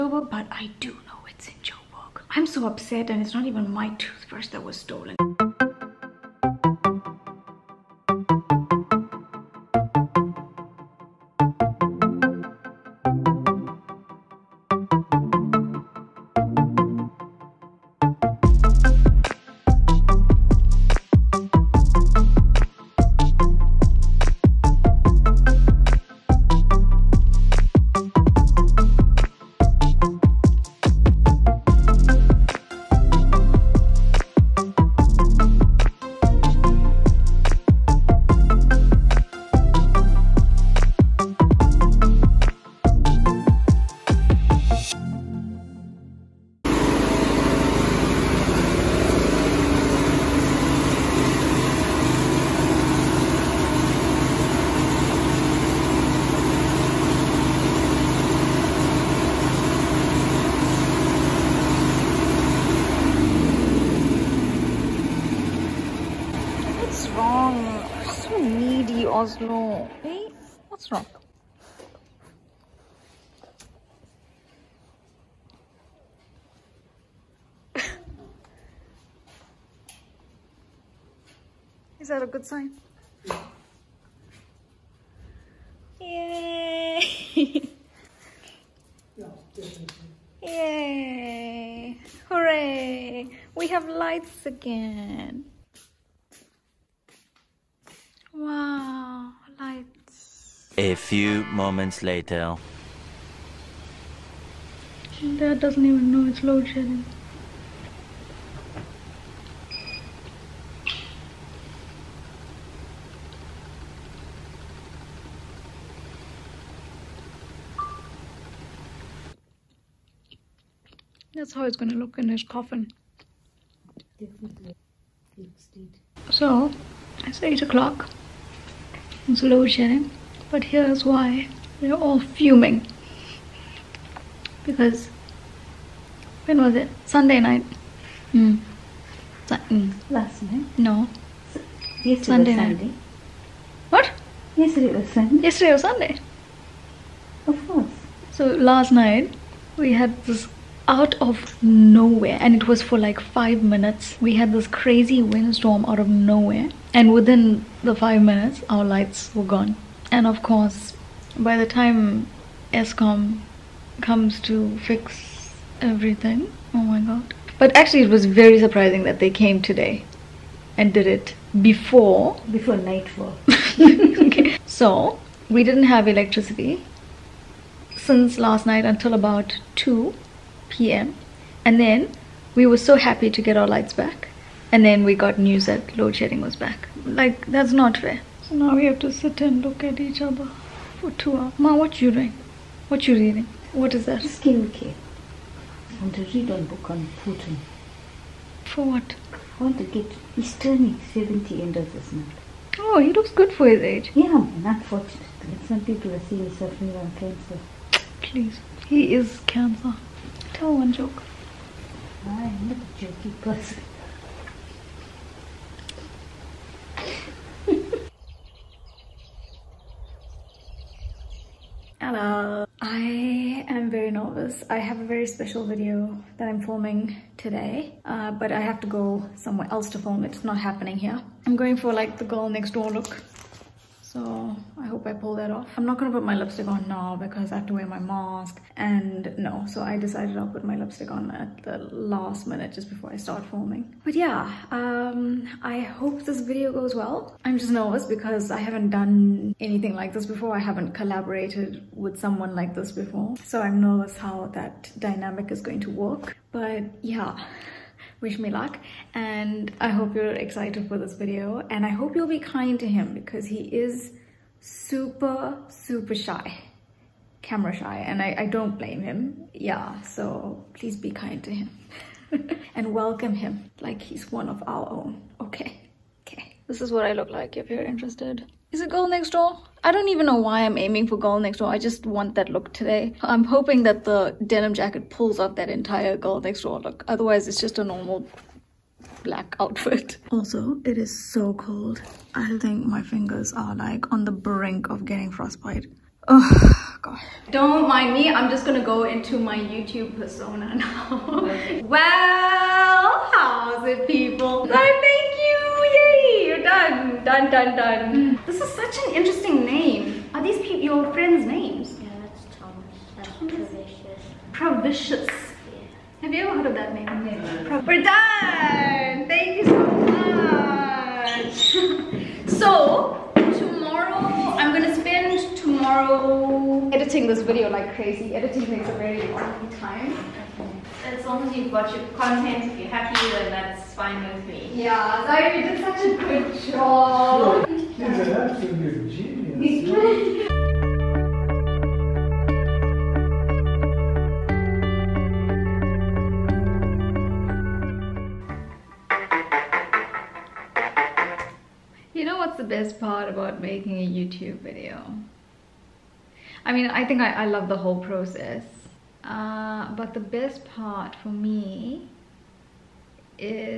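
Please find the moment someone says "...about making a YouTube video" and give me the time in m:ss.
5:53.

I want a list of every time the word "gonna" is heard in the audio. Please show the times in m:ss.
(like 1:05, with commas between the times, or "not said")
2:01, 3:55, 4:58, 5:24.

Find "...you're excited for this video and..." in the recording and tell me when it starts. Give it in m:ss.
4:20.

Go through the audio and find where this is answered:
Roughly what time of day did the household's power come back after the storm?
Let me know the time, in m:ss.
2:59.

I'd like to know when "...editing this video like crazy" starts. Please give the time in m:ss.
5:26.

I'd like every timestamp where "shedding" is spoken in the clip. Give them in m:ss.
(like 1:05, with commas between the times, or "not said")
1:46, 3:06.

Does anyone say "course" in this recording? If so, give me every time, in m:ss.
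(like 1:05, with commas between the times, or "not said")
2:27, 2:40.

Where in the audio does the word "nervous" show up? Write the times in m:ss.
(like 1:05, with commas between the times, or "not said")
3:44, 4:07, 4:13.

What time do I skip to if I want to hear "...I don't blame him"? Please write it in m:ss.
4:28.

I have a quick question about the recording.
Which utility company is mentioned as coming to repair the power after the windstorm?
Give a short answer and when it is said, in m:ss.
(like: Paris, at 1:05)
Eskom, at 2:42.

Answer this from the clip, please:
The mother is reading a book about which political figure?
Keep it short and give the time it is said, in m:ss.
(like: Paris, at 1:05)
Putin, at 3:17.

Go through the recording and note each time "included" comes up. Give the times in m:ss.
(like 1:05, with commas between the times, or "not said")
not said.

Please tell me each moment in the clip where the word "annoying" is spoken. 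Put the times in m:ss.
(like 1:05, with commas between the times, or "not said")
not said.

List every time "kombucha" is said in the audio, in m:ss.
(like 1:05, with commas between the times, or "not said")
not said.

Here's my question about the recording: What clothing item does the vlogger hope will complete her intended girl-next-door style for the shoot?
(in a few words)
Denim jacket.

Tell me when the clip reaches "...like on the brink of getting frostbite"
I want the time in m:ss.
4:53.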